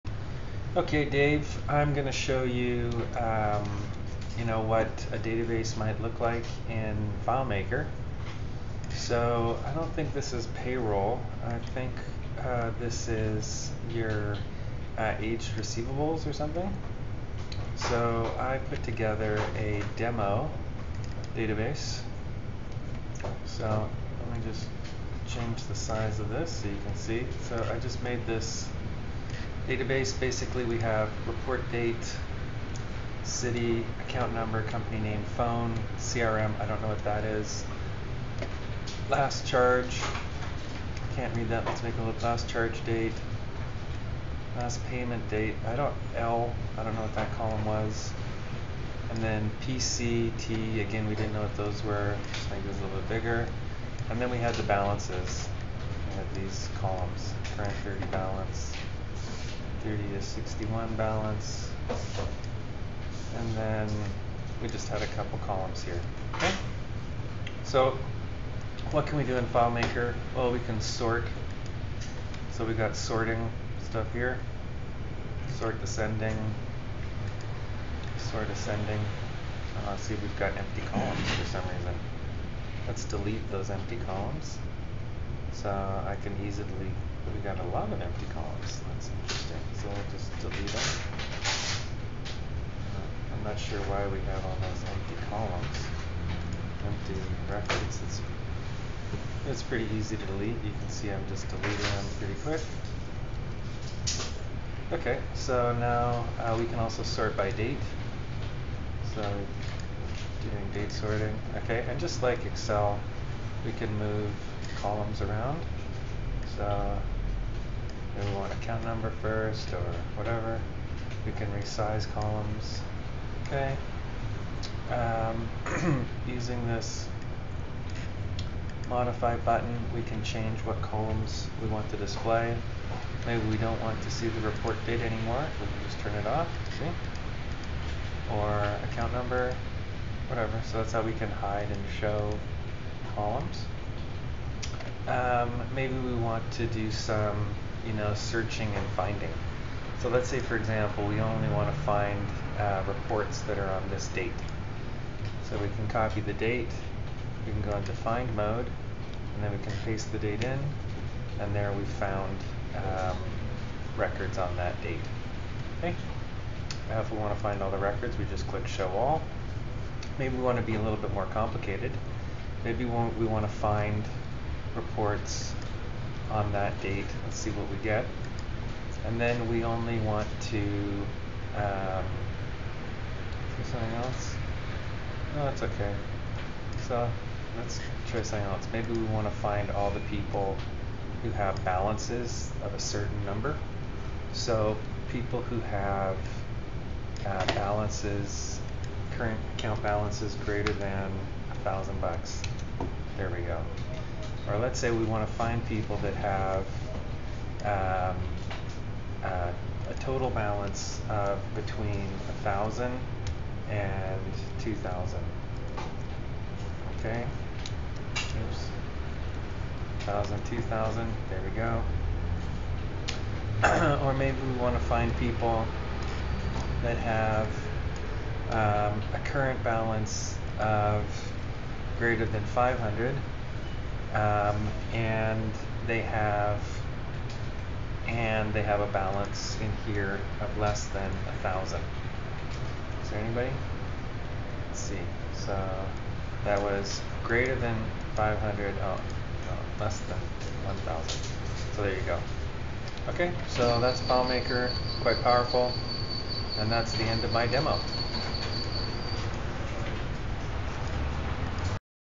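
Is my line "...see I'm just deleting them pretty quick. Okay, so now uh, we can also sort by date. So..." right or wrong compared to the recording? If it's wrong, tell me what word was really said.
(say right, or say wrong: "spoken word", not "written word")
right.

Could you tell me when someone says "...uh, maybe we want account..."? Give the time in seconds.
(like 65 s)
116 s.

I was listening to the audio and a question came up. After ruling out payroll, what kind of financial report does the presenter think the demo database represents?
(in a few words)
Aged receivables.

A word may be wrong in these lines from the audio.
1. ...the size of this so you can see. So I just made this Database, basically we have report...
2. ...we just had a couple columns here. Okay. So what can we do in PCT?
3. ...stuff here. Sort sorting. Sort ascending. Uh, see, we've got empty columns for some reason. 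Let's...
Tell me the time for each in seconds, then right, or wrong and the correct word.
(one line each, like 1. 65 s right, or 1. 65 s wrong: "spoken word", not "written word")
1. 25 s right
2. 64 s wrong: "FileMaker", not "PCT"
3. 73 s wrong: "descending", not "sorting".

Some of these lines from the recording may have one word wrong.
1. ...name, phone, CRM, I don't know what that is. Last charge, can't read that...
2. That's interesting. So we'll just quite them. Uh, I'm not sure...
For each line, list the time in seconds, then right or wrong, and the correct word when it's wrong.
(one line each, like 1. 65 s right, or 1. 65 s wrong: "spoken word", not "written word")
1. 34 s right
2. 88 s wrong: "delete", not "quite".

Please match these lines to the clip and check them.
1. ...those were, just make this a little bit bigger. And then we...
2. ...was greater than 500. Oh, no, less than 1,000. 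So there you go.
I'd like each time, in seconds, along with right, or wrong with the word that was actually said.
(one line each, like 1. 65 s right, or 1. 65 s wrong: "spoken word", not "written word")
1. 51 s right
2. 246 s right.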